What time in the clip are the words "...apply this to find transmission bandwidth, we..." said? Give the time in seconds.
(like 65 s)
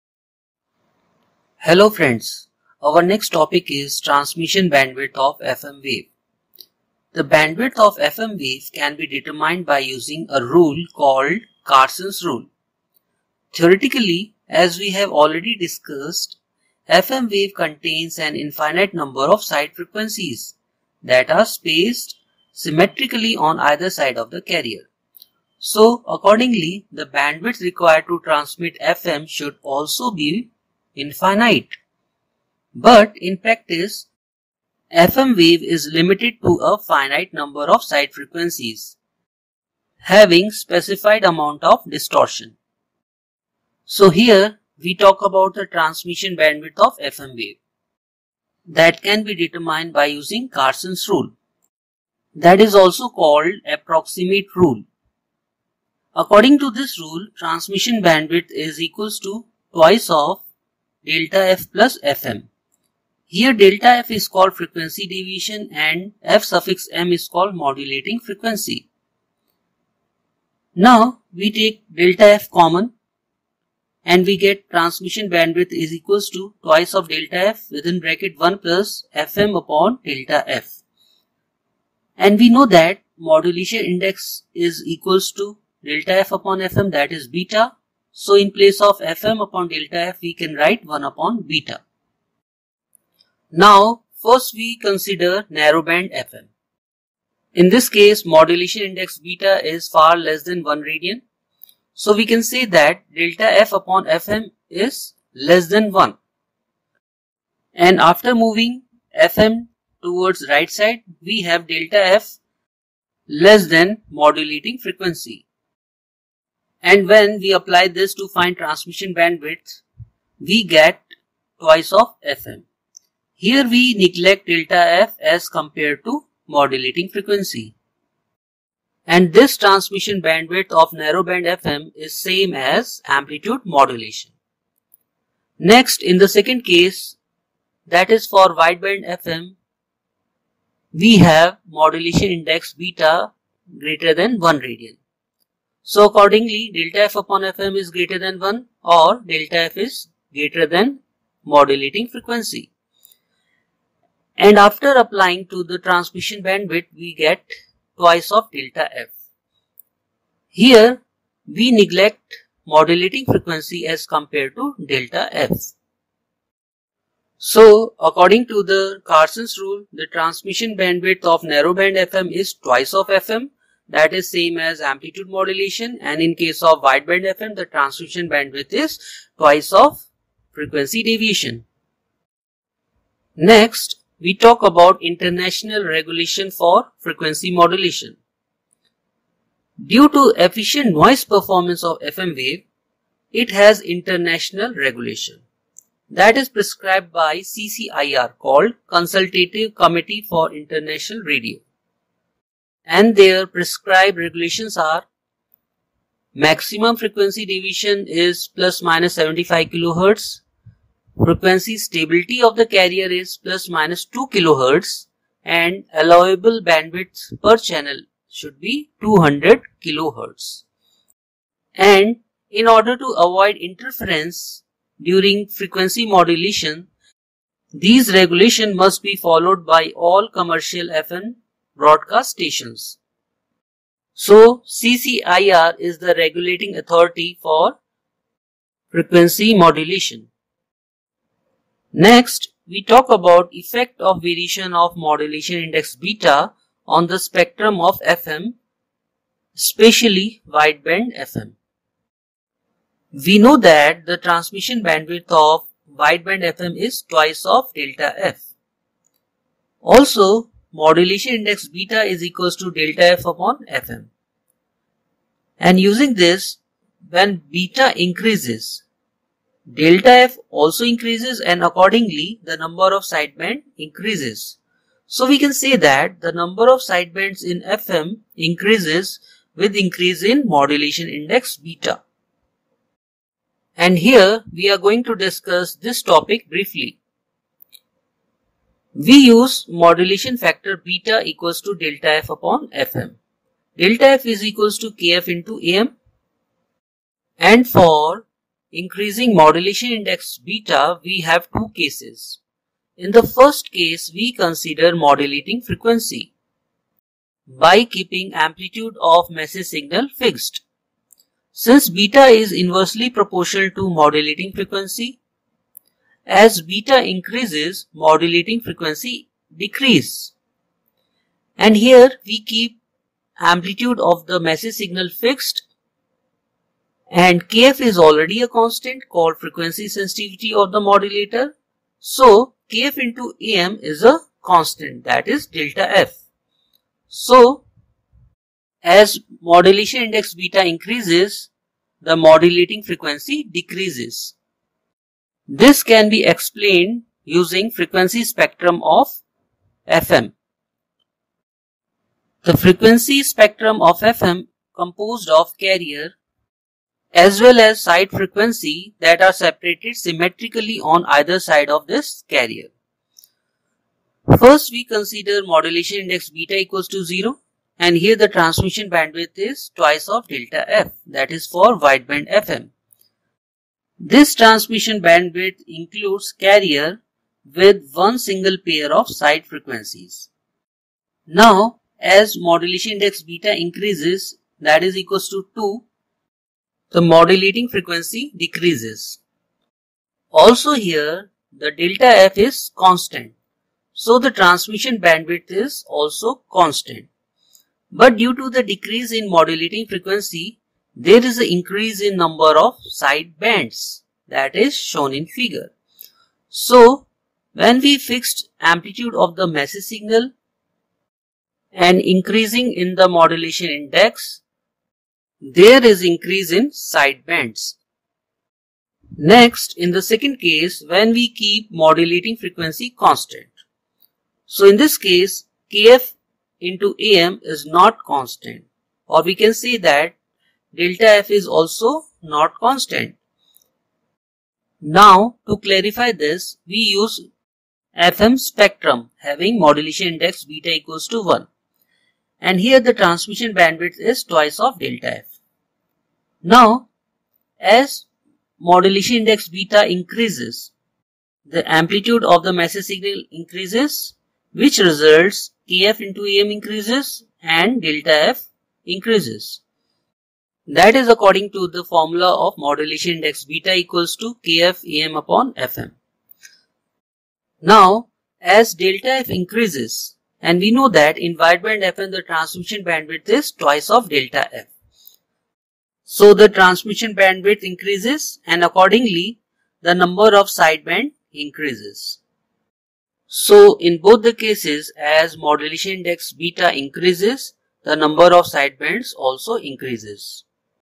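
117 s.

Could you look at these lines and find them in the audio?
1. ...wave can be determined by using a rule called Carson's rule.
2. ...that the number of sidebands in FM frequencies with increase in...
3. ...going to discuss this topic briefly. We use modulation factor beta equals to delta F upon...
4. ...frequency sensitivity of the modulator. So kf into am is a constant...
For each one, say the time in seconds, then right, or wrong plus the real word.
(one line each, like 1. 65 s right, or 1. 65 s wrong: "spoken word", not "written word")
1. 8 s right
2. 275 s wrong: "increases", not "frequencies"
3. 284 s right
4. 329 s right.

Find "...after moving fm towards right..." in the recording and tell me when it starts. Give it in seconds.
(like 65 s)
108 s.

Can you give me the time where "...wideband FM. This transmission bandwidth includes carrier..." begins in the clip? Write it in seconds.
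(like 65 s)
371 s.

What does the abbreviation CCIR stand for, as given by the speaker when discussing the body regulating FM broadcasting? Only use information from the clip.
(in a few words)
Consultative Committee for International Radio.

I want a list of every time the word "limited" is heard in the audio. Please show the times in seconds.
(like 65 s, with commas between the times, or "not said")
35 s.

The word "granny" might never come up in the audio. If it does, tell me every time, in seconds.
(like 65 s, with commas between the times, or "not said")
not said.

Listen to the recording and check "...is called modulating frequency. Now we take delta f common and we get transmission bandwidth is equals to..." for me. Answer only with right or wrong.
right.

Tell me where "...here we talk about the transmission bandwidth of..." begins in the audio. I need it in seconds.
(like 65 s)
44 s.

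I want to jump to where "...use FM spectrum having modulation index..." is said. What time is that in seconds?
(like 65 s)
436 s.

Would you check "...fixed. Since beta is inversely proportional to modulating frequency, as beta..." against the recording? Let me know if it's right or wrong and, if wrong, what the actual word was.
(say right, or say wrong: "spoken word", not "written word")
right.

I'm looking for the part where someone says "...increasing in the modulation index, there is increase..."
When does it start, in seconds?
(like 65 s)
411 s.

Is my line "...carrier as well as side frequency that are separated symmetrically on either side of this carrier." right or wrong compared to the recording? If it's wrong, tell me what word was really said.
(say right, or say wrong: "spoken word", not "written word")
right.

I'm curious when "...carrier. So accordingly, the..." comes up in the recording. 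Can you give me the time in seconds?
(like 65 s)
24 s.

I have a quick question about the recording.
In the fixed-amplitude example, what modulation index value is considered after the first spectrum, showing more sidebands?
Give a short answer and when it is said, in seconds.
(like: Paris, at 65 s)
2, at 384 s.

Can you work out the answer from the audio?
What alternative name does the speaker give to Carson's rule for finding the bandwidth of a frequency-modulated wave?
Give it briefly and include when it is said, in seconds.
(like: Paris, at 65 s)
approximate rule, at 53 s.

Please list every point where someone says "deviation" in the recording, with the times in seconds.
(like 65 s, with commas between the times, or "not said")
65 s, 181 s, 207 s.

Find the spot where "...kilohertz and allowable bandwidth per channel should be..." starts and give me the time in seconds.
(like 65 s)
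214 s.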